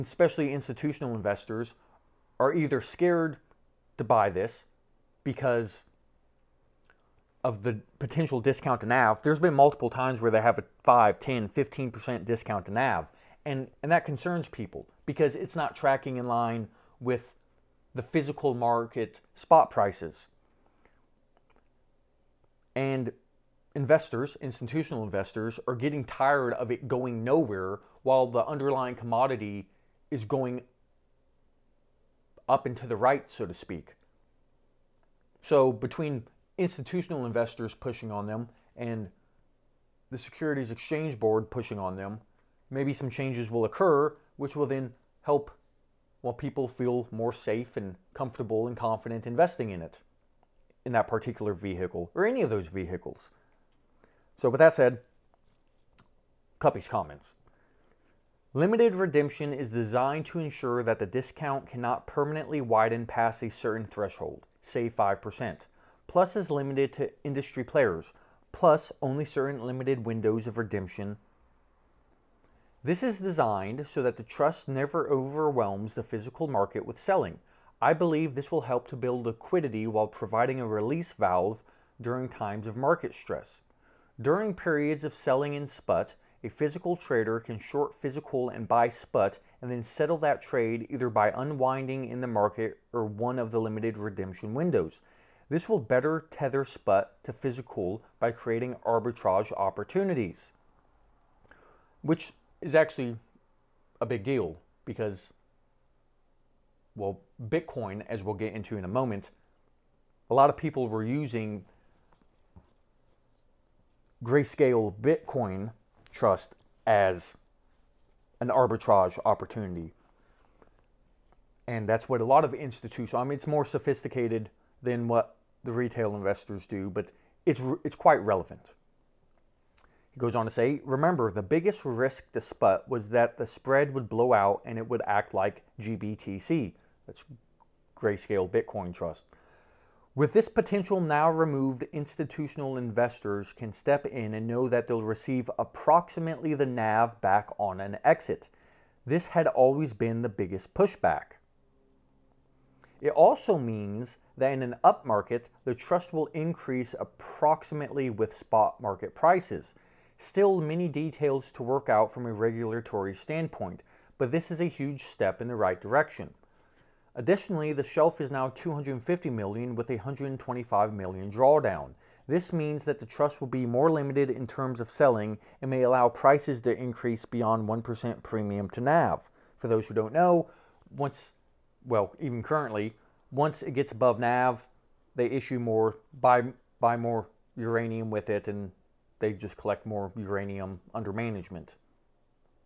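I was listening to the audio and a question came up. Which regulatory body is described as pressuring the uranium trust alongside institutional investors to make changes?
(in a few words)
Securities Exchange Board.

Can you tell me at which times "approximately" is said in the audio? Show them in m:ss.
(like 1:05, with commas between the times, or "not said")
2:25, 2:36.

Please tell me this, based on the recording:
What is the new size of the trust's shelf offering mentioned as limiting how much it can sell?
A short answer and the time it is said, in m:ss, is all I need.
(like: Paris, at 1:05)
250 million, at 2:48.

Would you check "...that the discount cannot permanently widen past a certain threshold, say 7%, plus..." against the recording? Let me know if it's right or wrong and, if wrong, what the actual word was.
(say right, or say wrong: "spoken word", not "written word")
wrong: "5", not "7".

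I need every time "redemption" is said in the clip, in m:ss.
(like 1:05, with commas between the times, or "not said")
0:58, 1:10, 1:33.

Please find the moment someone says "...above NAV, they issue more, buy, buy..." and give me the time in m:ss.
3:03.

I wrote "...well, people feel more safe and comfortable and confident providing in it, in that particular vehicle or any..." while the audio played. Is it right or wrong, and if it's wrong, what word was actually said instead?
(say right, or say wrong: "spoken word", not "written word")
wrong: "investing", not "providing".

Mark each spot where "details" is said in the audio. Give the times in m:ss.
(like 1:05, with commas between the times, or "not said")
2:40.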